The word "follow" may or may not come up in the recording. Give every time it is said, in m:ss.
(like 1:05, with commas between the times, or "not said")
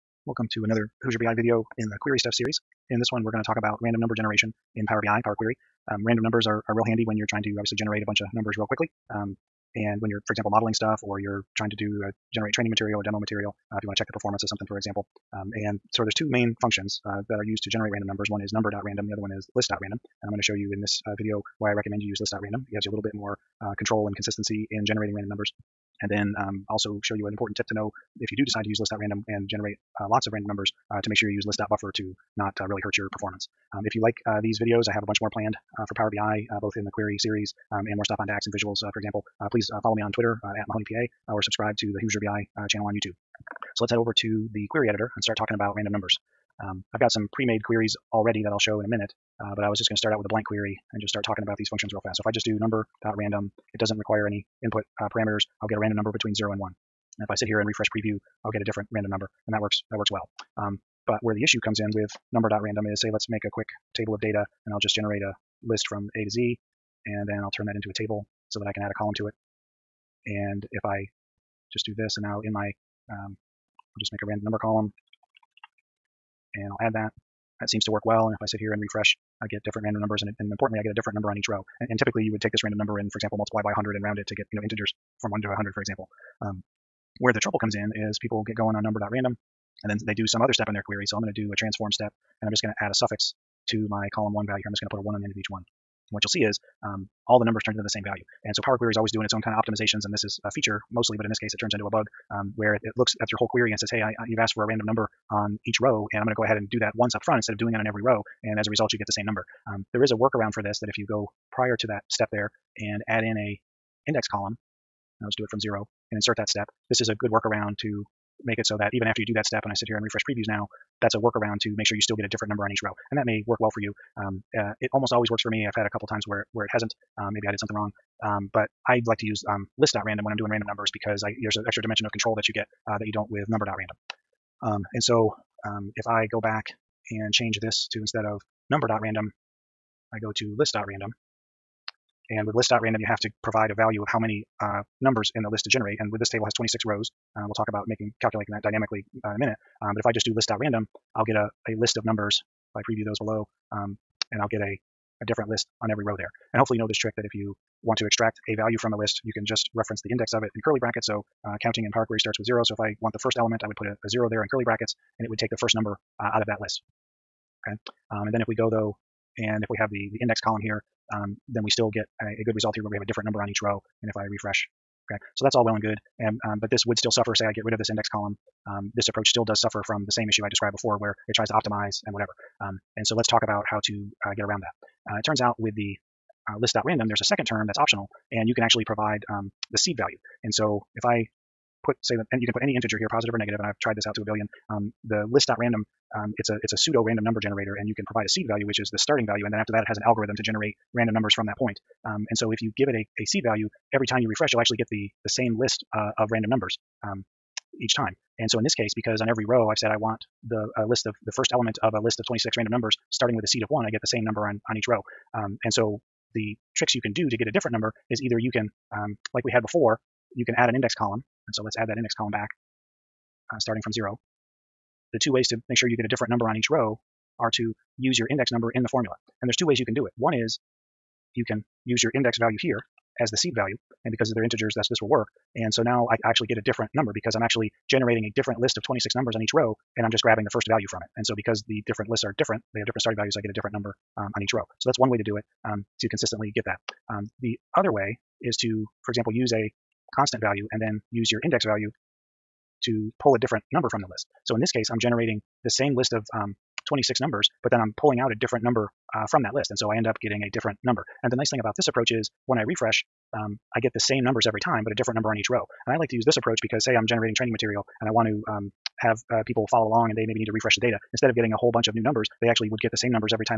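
0:39, 4:29.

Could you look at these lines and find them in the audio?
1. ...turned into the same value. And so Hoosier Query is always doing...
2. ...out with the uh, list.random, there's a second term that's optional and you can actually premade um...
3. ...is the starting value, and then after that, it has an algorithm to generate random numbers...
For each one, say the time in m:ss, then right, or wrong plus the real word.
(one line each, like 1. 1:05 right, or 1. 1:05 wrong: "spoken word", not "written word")
1. 1:37 wrong: "Power", not "Hoosier"
2. 3:05 wrong: "provide", not "premade"
3. 3:18 right.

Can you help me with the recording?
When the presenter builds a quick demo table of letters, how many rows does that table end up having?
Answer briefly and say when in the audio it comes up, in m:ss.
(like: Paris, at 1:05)
26, at 2:26.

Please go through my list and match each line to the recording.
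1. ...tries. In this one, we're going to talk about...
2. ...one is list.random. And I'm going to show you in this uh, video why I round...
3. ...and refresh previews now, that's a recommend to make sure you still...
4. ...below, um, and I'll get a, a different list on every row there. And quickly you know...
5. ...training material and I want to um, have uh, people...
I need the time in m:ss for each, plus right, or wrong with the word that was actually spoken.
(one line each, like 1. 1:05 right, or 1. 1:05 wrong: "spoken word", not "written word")
1. 0:02 wrong: "series", not "tries"
2. 0:19 wrong: "recommend", not "round"
3. 1:59 wrong: "workaround", not "recommend"
4. 2:33 wrong: "hopefully", not "quickly"
5. 4:27 right.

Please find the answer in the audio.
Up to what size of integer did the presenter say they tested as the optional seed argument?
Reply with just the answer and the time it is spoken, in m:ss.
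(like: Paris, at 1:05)
a billion, at 3:13.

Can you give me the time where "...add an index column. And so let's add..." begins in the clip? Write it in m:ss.
3:40.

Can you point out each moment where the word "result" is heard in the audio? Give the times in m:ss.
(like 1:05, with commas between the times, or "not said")
1:48, 2:52.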